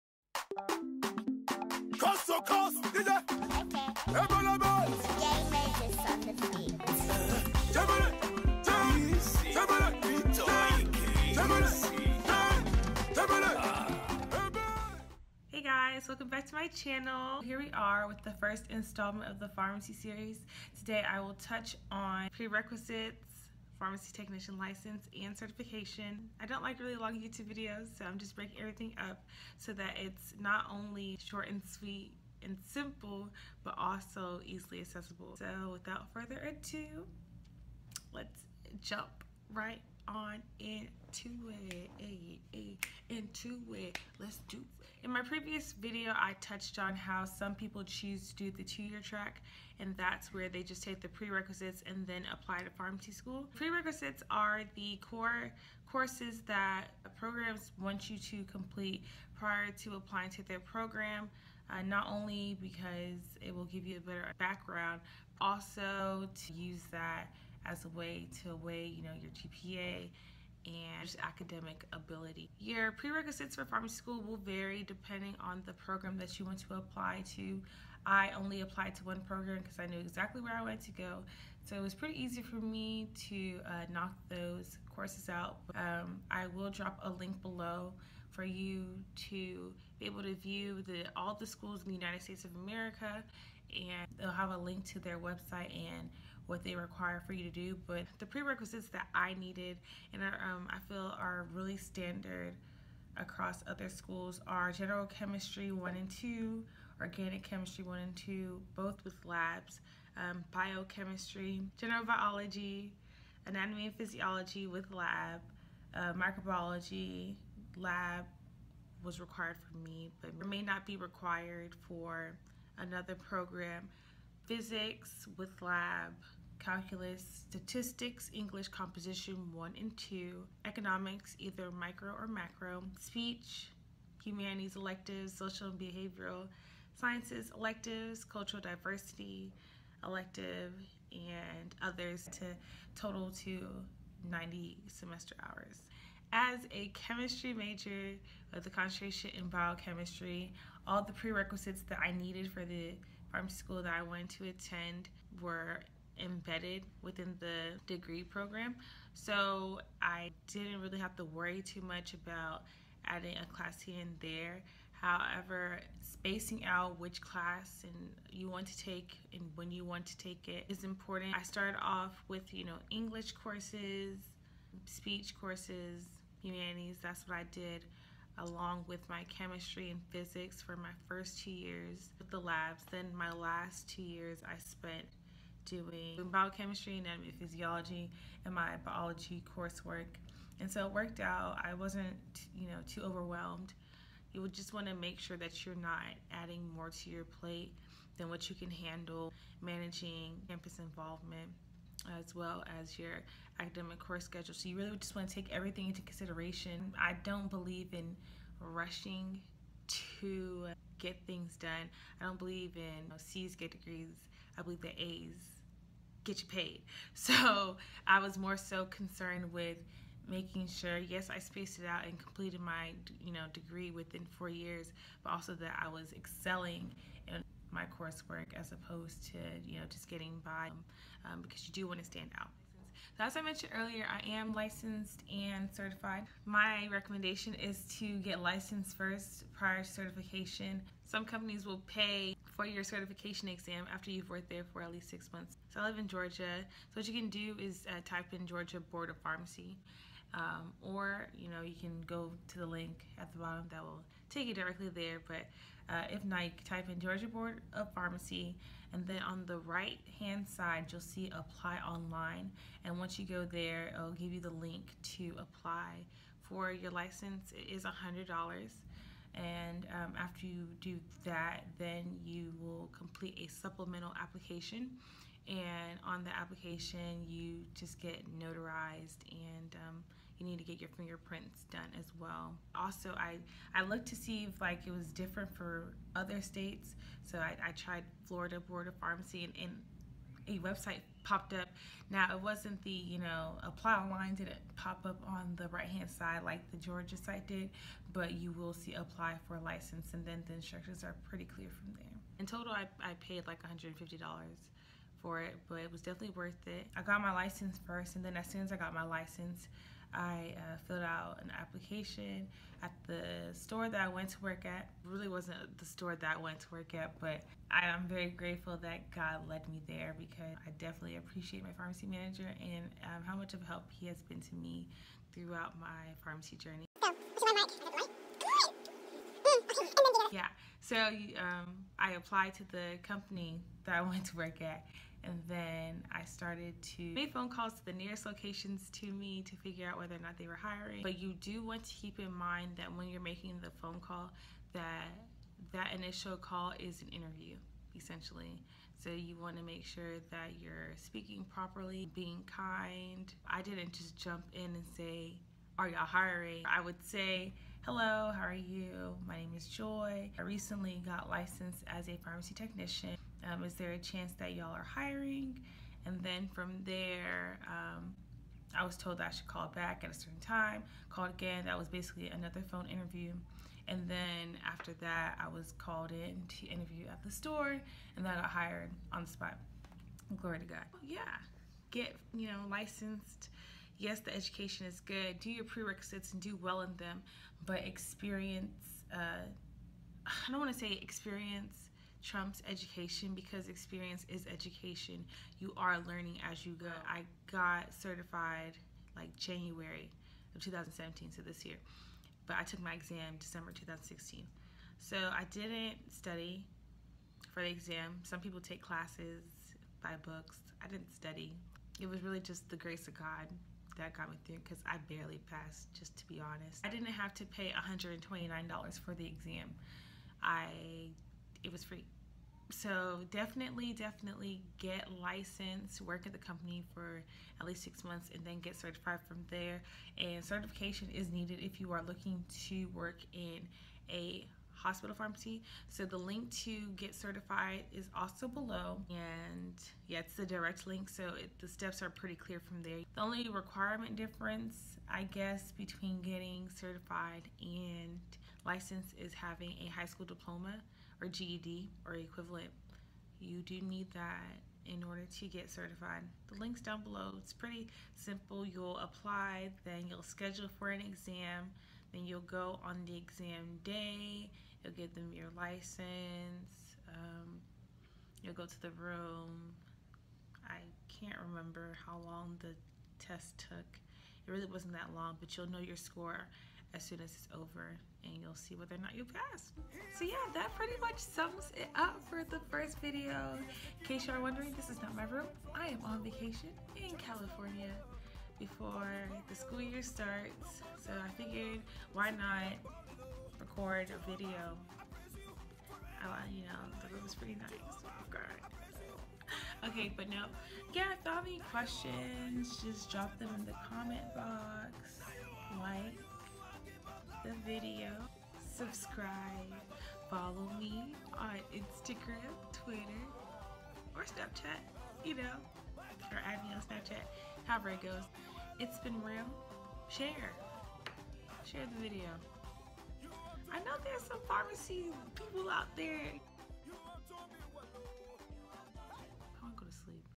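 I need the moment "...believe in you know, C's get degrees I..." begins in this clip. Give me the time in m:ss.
3:32.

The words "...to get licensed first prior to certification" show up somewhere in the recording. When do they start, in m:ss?
3:57.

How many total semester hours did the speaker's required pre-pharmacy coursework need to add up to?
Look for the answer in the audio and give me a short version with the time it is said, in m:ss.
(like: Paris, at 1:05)
90, at 2:24.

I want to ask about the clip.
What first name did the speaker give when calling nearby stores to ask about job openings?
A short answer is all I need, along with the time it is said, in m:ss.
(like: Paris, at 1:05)
Joy, at 5:59.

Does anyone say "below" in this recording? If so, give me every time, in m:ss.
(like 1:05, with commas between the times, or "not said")
1:27, 7:18, 7:37.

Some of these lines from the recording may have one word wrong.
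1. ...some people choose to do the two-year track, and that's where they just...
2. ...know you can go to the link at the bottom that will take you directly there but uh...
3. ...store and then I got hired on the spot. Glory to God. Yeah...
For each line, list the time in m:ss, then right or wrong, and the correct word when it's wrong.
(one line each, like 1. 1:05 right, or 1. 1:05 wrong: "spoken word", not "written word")
1. 0:47 right
2. 4:11 right
3. 6:17 right.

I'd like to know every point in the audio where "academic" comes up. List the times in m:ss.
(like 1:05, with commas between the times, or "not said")
1:11, 3:23.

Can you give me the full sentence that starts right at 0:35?
So without further ado, let's jump right on into it, eh, eh, into it.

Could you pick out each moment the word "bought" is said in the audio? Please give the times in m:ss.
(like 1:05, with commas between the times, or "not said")
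not said.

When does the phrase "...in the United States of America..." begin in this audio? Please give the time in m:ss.
1:31.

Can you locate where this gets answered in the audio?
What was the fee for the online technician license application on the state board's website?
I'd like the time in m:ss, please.
4:28.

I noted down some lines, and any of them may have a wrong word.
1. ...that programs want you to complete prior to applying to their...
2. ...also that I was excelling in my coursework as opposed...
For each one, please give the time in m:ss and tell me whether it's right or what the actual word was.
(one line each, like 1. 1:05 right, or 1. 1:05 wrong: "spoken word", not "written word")
1. 0:56 right
2. 3:45 right.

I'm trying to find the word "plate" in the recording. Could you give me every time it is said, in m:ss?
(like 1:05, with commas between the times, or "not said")
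3:17.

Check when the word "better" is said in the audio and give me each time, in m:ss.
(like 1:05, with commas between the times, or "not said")
1:04.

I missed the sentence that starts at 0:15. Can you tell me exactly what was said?
Hey guys, welcome back to my channel.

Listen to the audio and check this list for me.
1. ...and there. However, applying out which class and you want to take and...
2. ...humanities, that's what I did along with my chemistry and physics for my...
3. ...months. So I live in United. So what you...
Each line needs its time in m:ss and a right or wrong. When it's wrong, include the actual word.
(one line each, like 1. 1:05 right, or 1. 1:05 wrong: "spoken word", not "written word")
1. 2:44 wrong: "spacing", not "applying"
2. 2:56 right
3. 4:05 wrong: "Georgia", not "United".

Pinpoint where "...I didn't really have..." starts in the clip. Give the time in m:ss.
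2:40.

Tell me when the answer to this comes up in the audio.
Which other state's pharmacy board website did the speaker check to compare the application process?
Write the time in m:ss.
4:48.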